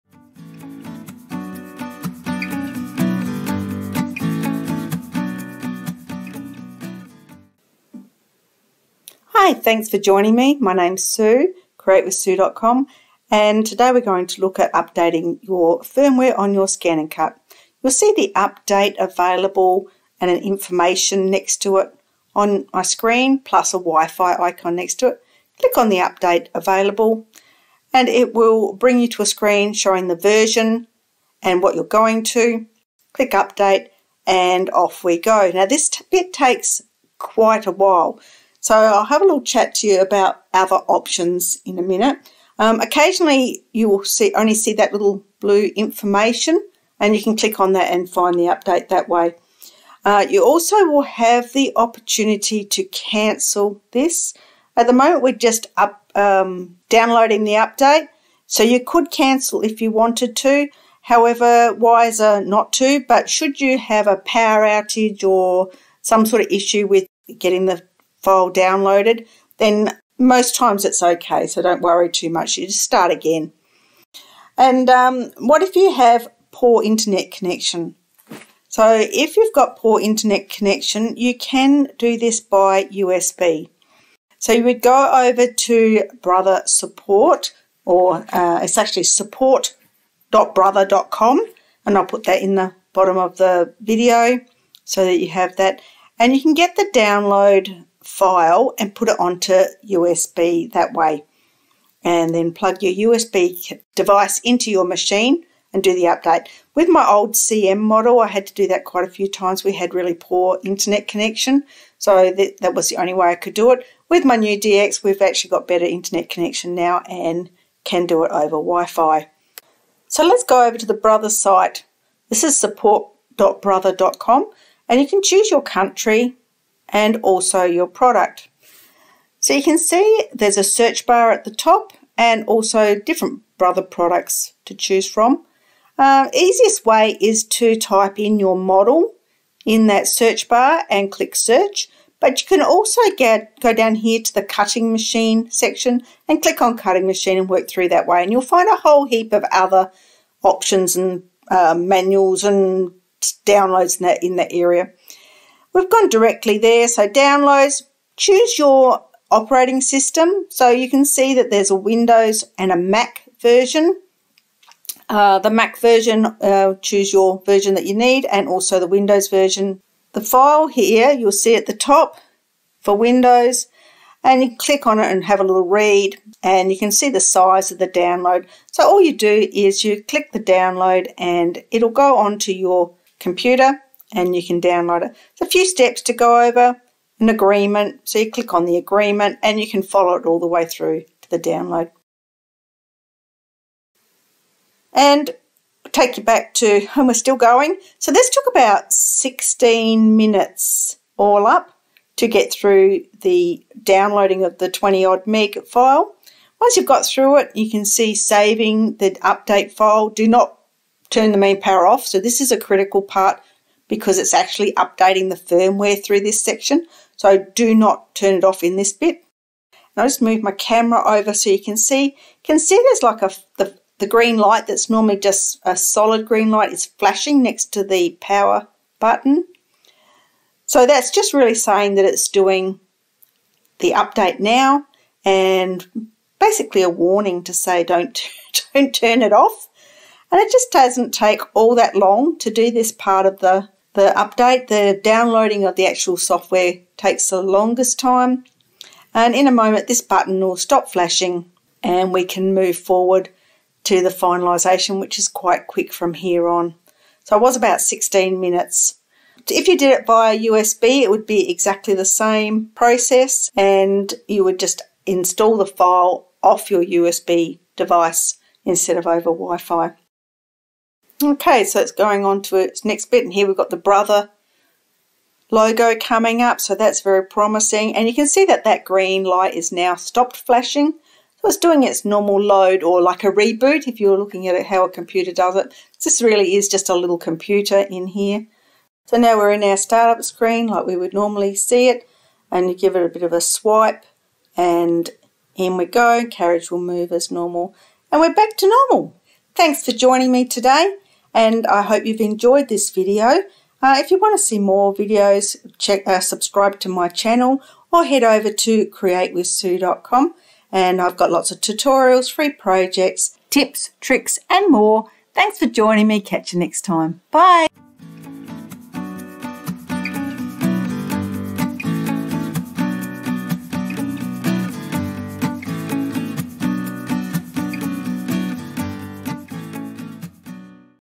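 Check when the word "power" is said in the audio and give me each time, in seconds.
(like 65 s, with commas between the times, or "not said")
64 s, 211 s, 228 s.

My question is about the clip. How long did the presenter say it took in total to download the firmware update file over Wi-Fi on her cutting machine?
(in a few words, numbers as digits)
16 minutes.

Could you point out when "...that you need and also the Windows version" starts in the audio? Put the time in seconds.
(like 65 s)
167 s.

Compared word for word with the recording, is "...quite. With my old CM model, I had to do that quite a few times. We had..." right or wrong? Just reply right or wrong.
wrong.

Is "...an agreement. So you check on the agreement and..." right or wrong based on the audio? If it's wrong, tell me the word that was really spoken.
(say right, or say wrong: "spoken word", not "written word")
wrong: "click", not "check".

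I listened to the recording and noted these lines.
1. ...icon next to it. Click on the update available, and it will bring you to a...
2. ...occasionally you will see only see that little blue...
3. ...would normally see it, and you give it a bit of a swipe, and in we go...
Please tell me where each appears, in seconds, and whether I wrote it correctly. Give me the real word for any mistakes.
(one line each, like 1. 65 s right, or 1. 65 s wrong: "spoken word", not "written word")
1. 24 s right
2. 42 s right
3. 290 s right.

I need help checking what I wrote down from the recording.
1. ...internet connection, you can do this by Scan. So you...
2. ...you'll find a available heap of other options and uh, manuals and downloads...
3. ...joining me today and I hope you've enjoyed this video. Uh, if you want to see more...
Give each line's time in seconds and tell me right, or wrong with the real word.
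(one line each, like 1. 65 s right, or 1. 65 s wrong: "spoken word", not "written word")
1. 79 s wrong: "USB", not "Scan"
2. 148 s wrong: "whole", not "available"
3. 299 s right.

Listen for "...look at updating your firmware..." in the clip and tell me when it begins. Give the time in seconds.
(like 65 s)
14 s.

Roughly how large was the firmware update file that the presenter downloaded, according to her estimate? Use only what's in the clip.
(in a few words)
20 meg.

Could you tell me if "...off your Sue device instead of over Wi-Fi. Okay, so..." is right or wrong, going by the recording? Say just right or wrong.
wrong.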